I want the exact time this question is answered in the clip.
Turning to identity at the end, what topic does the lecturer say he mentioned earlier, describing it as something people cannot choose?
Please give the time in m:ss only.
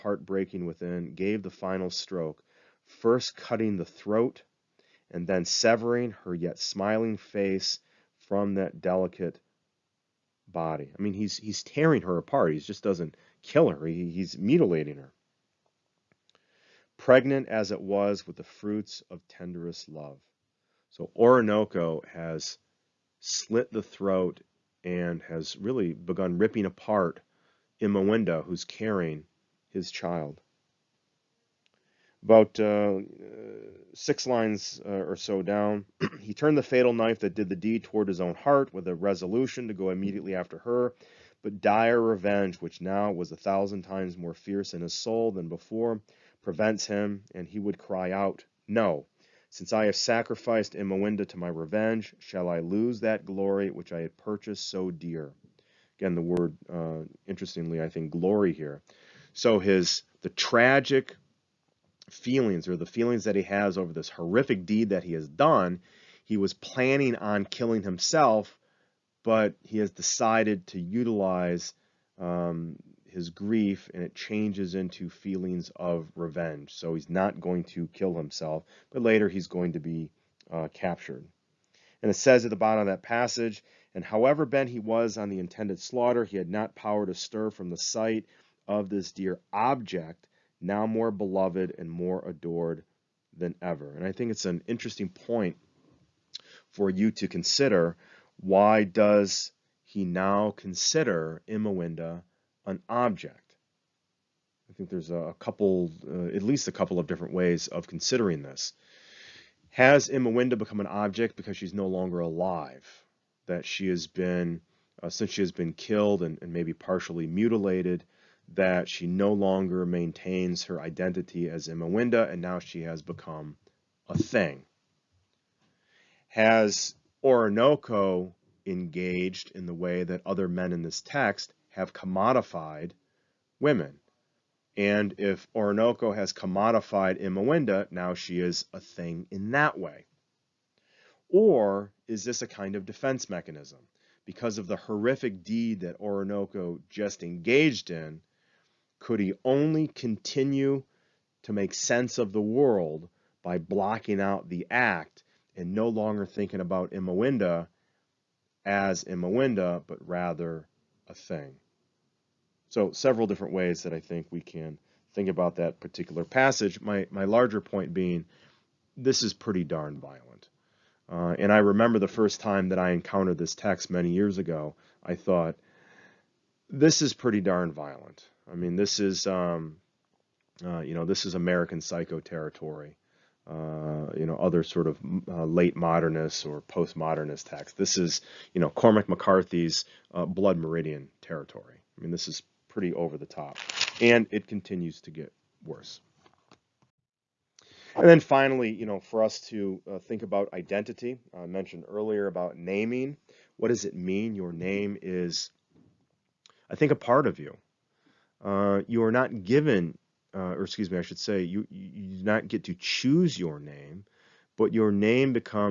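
3:22.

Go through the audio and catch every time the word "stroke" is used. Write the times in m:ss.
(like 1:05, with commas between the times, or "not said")
0:01.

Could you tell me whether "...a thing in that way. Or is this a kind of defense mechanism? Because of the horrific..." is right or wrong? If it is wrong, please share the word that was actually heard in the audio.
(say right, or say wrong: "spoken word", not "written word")
right.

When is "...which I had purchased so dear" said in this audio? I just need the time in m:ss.
0:53.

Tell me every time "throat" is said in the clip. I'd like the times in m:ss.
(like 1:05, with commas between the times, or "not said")
0:03, 0:23.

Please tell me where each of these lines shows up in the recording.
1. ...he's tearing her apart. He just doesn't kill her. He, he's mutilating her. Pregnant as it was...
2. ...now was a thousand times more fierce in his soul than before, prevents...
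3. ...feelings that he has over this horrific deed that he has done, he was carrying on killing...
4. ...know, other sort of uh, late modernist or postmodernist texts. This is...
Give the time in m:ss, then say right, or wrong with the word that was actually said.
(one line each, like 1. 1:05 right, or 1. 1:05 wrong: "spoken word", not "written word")
1. 0:11 right
2. 0:42 right
3. 1:02 wrong: "planning", not "carrying"
4. 3:04 right.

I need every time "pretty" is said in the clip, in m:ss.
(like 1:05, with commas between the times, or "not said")
2:49, 2:57, 3:12.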